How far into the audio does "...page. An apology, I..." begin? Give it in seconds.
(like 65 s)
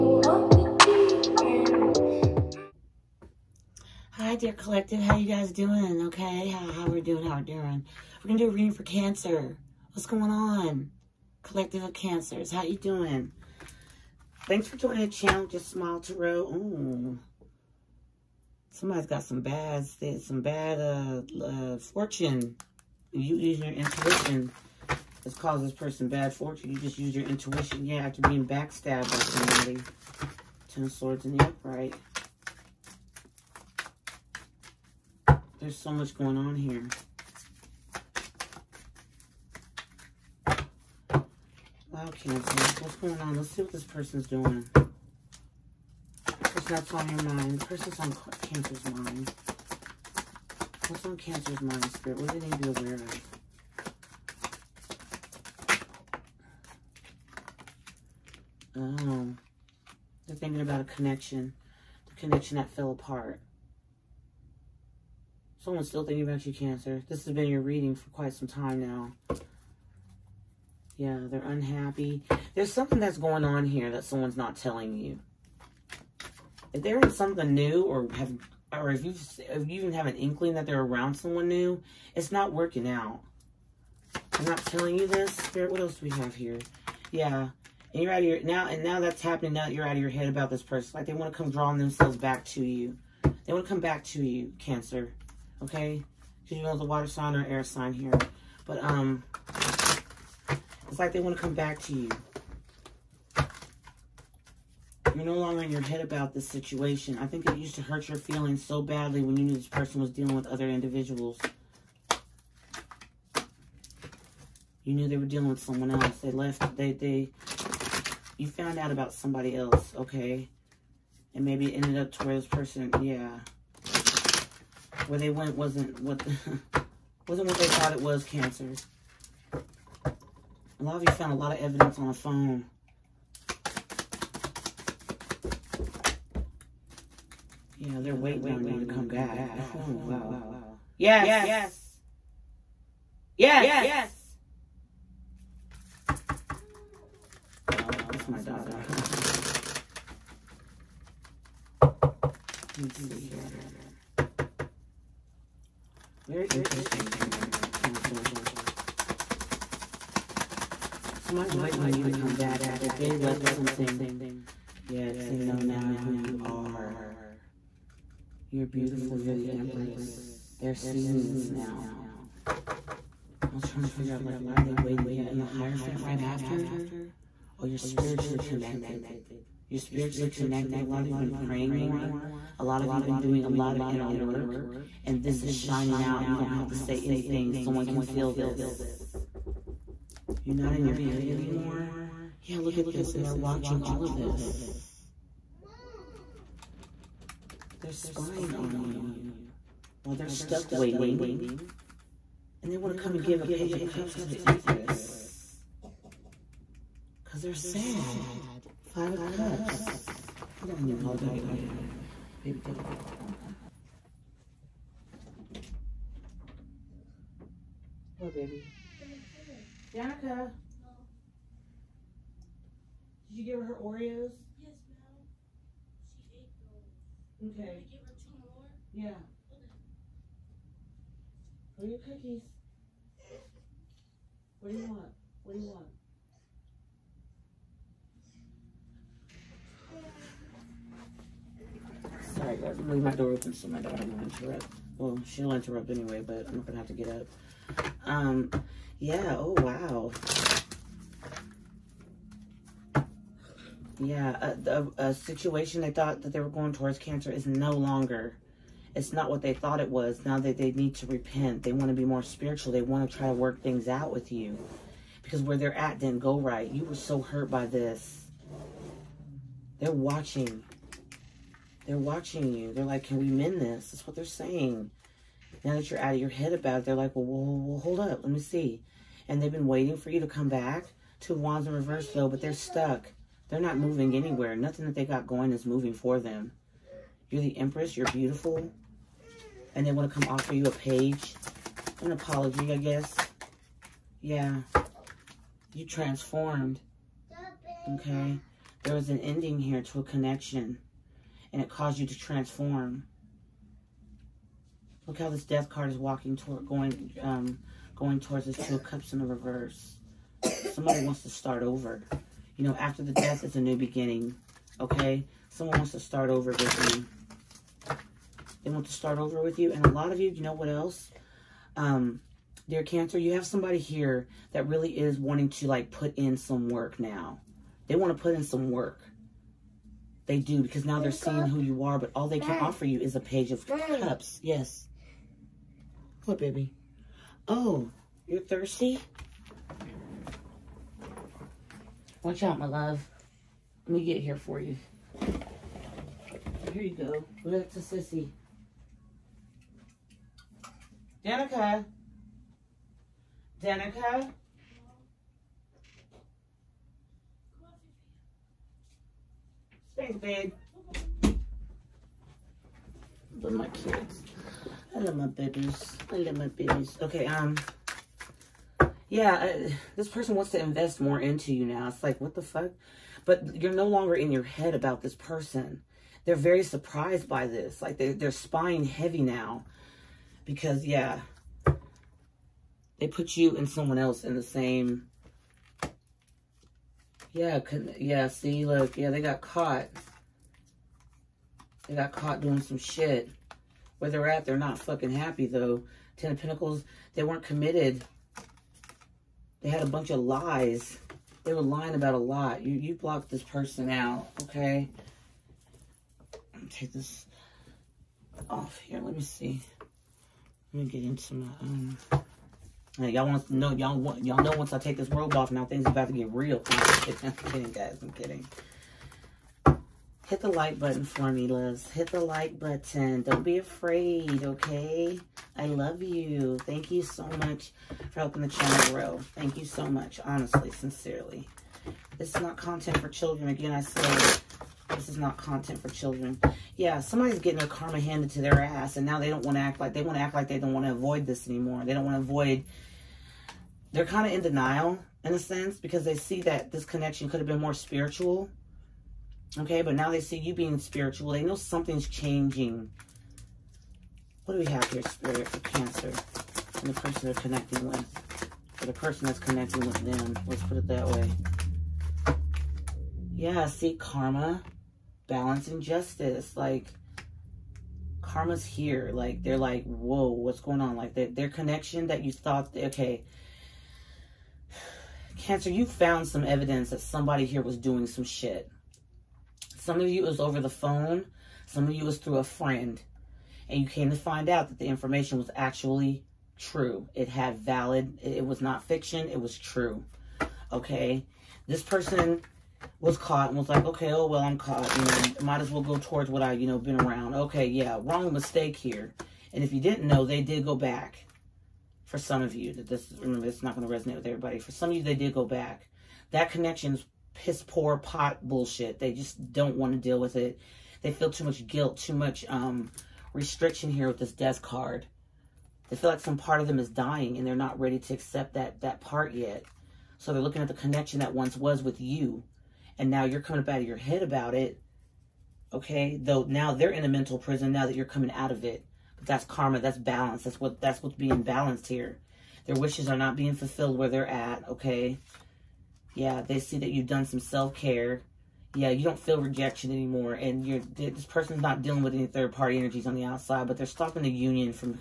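290 s.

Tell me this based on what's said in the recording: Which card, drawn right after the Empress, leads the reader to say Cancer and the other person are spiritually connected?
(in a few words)
The Hierophant.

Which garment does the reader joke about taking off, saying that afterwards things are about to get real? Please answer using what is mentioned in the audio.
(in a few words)
robe.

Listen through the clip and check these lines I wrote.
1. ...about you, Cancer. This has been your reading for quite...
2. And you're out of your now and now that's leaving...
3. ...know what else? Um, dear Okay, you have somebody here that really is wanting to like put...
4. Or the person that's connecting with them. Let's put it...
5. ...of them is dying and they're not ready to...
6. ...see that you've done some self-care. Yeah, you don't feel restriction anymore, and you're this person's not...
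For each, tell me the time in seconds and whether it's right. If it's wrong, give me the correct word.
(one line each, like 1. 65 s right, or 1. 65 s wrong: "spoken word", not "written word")
1. 66 s right
2. 87 s wrong: "happening", not "leaving"
3. 320 s wrong: "Cancer", not "Okay"
4. 458 s right
5. 516 s right
6. 536 s wrong: "rejection", not "restriction".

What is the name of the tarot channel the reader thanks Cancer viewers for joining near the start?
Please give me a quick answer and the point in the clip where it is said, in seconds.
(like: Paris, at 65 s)
Just Smile Tarot, at 15 s.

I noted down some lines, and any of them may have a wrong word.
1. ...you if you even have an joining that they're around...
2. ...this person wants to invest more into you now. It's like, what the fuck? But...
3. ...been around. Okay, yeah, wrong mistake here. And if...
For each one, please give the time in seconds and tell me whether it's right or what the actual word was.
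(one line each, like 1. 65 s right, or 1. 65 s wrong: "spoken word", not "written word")
1. 79 s wrong: "inkling", not "joining"
2. 369 s right
3. 496 s right.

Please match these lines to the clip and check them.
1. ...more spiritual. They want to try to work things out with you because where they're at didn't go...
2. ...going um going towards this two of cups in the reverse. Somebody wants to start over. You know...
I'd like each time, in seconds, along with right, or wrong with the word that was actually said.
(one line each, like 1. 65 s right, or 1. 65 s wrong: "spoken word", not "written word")
1. 262 s right
2. 306 s right.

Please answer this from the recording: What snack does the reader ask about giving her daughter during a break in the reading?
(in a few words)
Oreos.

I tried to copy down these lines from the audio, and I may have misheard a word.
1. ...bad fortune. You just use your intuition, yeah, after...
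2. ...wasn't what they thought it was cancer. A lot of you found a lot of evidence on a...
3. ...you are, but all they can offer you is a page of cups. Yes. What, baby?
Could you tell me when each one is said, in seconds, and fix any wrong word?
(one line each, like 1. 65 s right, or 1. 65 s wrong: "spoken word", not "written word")
1. 26 s right
2. 127 s right
3. 331 s right.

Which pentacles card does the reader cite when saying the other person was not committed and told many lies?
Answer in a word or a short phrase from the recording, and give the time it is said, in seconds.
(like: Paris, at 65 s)
Ten of Pentacles, at 396 s.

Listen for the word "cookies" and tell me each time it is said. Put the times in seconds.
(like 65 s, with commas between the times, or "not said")
231 s.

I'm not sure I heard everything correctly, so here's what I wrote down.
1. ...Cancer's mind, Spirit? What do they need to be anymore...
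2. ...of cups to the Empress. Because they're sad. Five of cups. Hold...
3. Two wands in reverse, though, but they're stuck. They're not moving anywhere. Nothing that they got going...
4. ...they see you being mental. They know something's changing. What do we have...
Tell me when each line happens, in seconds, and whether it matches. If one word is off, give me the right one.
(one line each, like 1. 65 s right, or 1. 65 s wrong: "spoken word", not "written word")
1. 51 s wrong: "aware", not "anymore"
2. 203 s right
3. 281 s right
4. 450 s wrong: "spiritual", not "mental".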